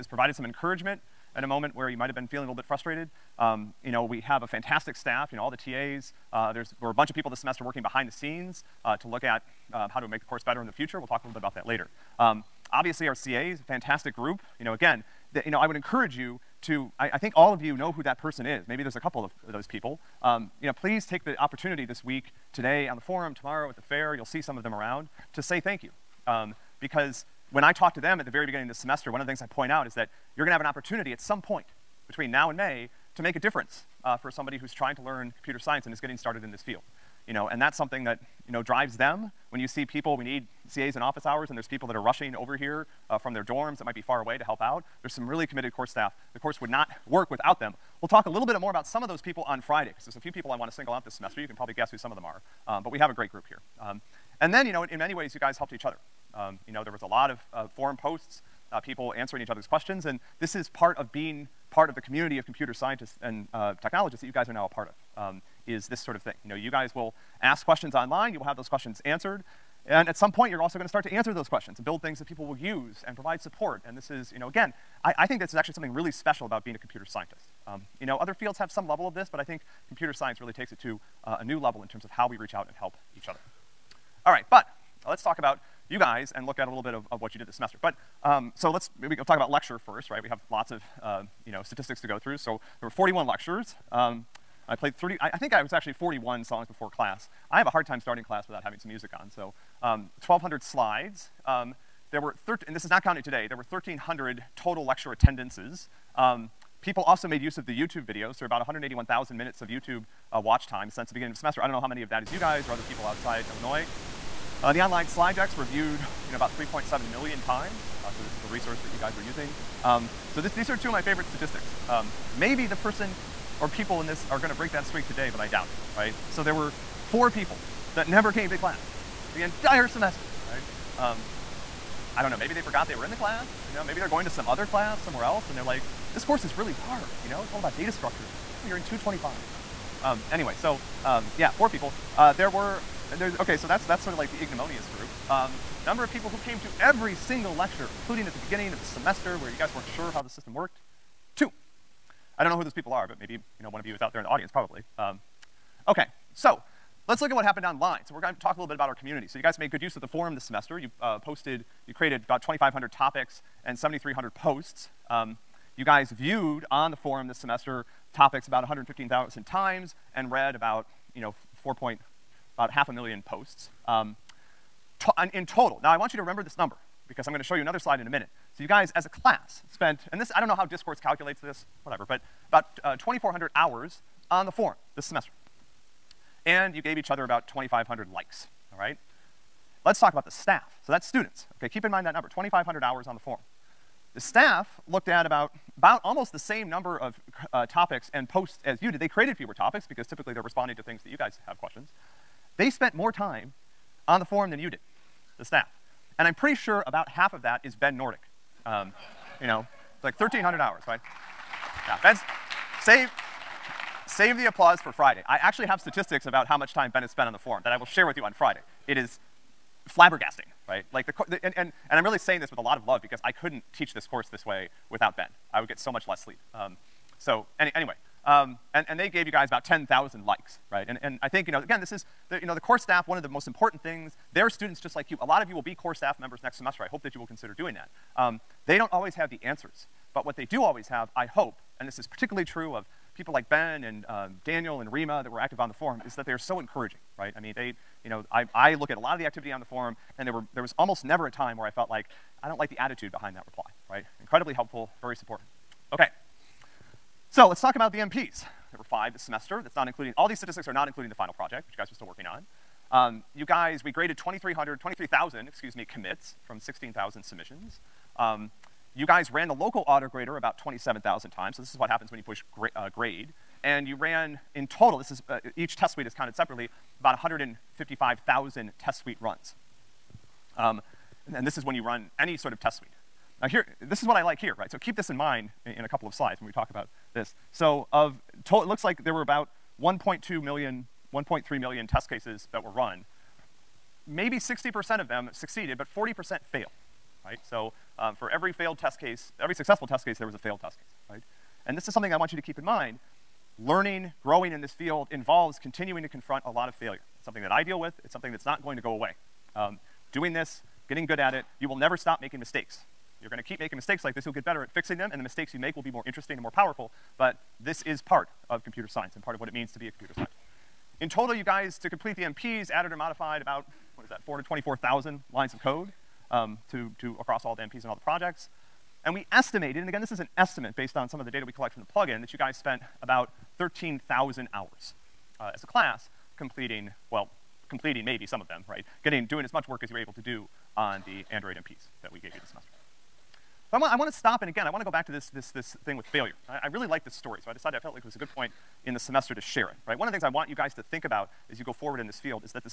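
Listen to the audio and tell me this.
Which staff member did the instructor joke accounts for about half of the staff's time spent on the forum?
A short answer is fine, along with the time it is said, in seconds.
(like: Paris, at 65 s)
Ben Nordick, at 207 s.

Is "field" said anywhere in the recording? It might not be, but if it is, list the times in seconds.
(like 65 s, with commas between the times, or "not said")
36 s, 78 s, 304 s, 352 s.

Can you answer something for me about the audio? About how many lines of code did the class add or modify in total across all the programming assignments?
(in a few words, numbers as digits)
424,000.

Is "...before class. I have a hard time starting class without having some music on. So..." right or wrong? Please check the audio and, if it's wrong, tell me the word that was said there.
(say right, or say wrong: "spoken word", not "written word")
right.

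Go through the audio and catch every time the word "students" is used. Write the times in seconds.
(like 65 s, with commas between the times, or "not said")
191 s, 234 s.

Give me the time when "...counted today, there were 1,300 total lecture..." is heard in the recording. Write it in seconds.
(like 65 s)
103 s.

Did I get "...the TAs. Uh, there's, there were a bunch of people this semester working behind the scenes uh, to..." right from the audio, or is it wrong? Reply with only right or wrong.
right.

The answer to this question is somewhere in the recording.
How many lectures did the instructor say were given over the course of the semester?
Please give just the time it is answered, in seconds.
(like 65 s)
92 s.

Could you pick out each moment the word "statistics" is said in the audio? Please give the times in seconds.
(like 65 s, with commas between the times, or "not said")
91 s, 121 s, 215 s, 260 s.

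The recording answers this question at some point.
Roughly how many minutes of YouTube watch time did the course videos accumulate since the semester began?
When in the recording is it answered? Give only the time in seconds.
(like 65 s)
108 s.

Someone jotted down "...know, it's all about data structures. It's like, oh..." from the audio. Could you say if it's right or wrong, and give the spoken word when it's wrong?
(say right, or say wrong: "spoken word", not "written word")
right.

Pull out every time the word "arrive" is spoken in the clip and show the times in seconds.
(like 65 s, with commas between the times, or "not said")
not said.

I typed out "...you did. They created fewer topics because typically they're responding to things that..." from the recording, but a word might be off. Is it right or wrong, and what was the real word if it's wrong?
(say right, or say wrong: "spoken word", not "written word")
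right.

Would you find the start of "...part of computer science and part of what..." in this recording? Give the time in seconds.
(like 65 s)
318 s.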